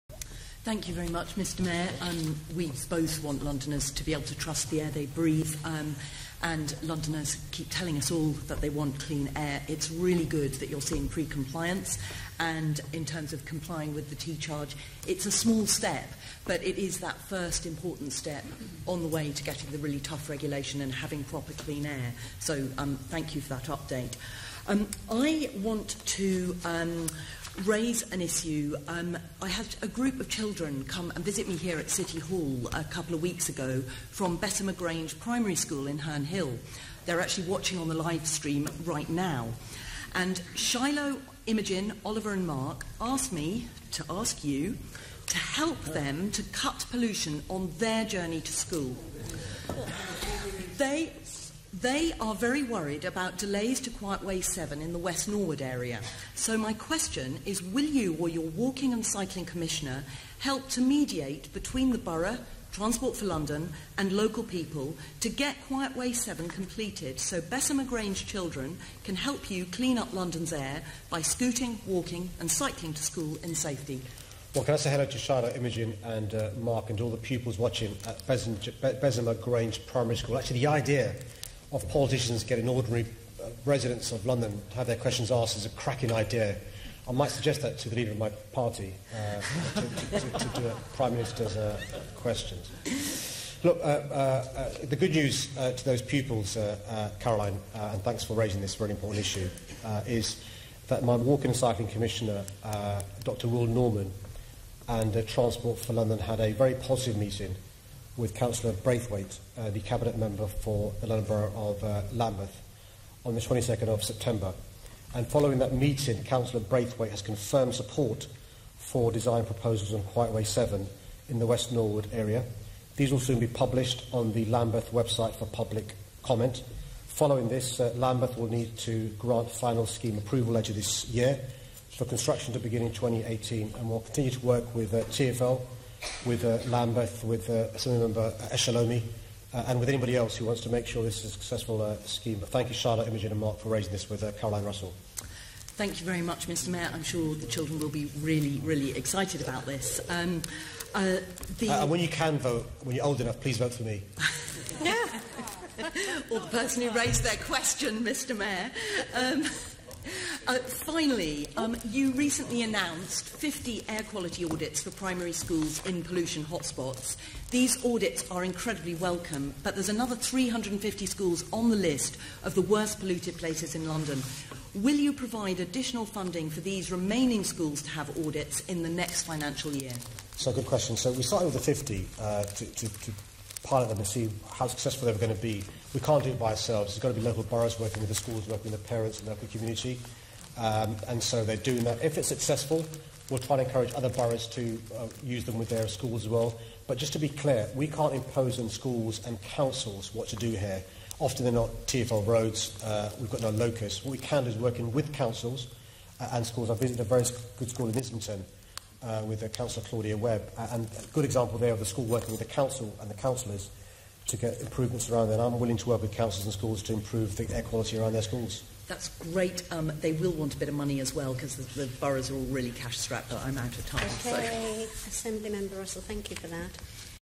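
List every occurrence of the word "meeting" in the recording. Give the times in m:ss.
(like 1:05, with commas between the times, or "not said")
1:47, 1:55.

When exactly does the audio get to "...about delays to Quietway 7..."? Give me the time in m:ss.
0:53.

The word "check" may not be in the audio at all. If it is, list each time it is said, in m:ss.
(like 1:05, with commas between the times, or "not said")
not said.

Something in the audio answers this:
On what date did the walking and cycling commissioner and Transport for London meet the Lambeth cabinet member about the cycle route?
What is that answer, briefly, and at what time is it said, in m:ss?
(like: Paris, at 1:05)
22nd of September, at 1:53.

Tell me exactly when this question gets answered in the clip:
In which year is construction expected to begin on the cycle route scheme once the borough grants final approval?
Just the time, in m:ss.
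2:12.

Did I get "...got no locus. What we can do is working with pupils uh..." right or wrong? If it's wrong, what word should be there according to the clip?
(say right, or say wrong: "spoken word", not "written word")
wrong: "councils", not "pupils".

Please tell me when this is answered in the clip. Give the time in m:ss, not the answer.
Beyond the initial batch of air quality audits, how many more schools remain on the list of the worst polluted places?
2:50.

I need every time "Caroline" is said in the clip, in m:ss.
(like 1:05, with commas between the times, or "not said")
1:37, 2:24.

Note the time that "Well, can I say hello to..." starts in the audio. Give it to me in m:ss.
1:14.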